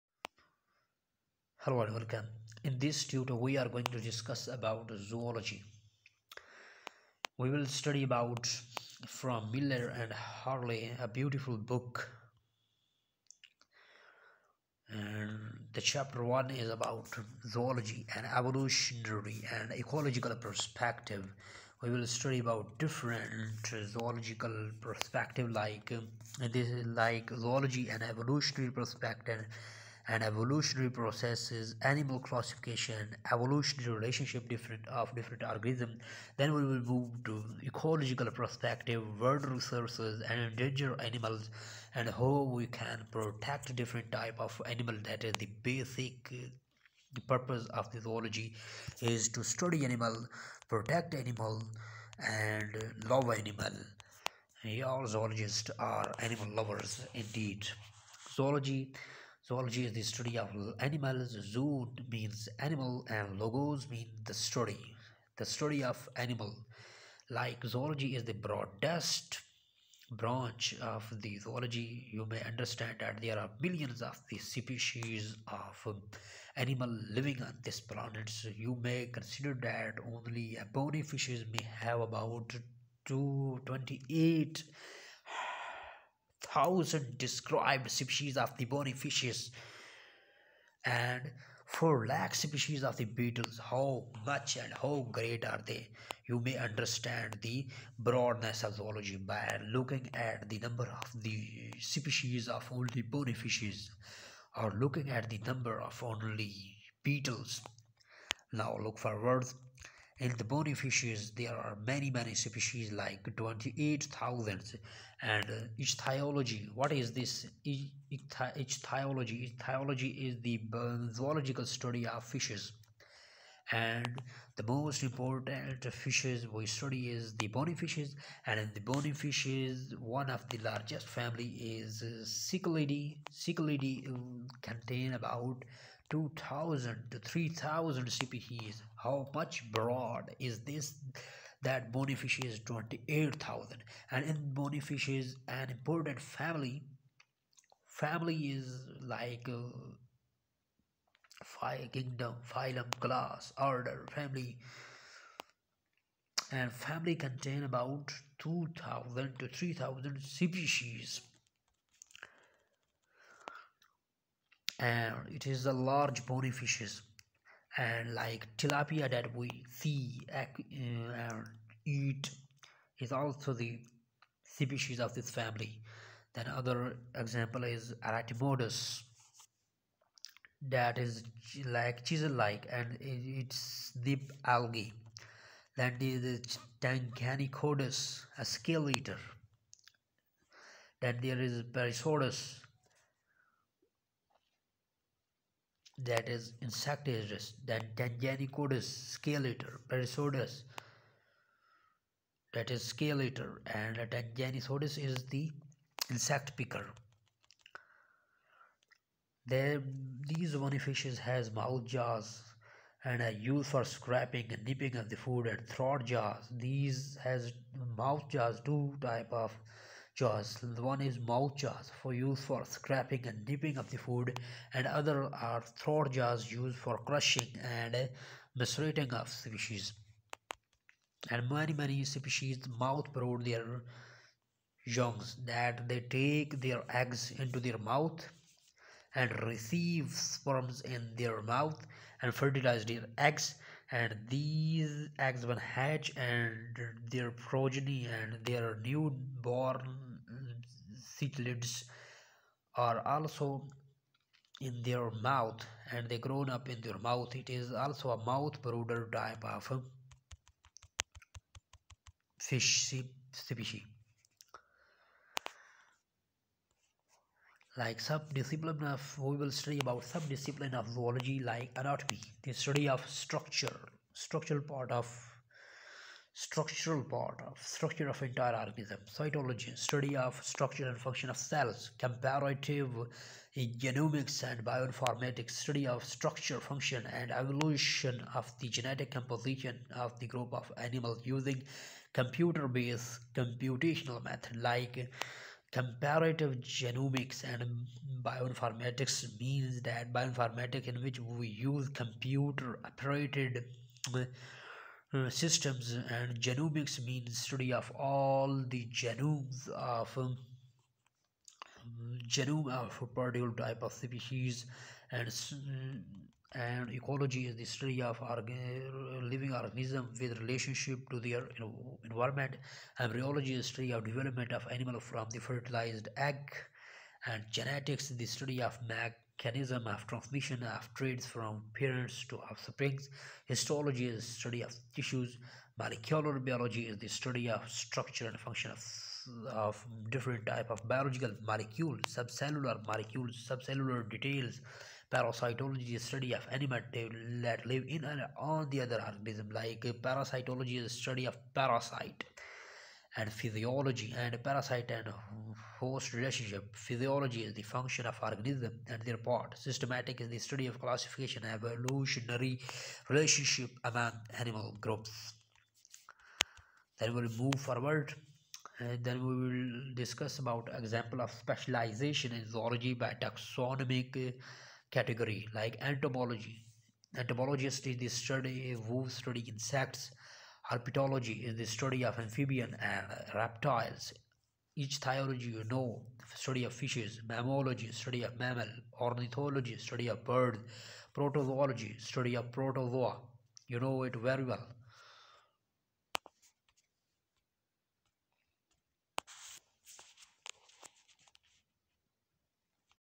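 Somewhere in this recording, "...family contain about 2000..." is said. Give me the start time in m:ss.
2:36.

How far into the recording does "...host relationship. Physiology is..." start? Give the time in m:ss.
5:55.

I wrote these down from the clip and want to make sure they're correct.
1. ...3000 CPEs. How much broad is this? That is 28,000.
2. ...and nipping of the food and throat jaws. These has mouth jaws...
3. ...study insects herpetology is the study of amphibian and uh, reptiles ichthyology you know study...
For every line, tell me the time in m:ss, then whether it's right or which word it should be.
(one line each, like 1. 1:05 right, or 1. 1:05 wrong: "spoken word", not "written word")
1. 2:17 right
2. 3:34 right
3. 6:19 right.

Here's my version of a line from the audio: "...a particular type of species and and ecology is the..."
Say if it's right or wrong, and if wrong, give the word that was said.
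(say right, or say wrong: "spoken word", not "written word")
right.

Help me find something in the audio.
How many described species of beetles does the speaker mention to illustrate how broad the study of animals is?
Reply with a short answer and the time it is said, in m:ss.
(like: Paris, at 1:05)
4 lakh, at 1:31.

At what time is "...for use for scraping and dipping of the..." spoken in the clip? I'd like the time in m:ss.
3:42.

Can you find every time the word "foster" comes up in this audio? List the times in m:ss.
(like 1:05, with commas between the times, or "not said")
not said.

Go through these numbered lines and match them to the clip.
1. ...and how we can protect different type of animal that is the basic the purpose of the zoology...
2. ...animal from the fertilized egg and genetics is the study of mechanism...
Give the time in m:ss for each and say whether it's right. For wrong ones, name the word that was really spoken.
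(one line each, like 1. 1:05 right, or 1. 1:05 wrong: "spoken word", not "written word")
1. 0:41 right
2. 5:24 right.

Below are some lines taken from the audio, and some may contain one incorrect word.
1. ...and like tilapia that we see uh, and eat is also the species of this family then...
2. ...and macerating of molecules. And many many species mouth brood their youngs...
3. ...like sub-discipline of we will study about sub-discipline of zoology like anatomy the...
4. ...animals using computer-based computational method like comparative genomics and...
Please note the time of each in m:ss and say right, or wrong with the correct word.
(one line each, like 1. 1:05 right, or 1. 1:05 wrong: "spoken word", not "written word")
1. 2:47 right
2. 3:47 wrong: "species", not "molecules"
3. 4:27 right
4. 4:50 right.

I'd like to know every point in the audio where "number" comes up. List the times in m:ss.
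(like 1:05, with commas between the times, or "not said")
1:40, 1:45.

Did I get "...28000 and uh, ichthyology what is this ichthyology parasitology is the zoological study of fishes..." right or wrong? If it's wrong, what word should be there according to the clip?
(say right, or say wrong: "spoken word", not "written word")
wrong: "ichthyology", not "parasitology".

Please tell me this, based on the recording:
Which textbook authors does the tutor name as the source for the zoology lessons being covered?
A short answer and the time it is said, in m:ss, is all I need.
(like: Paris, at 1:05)
Miller and Harley, at 0:09.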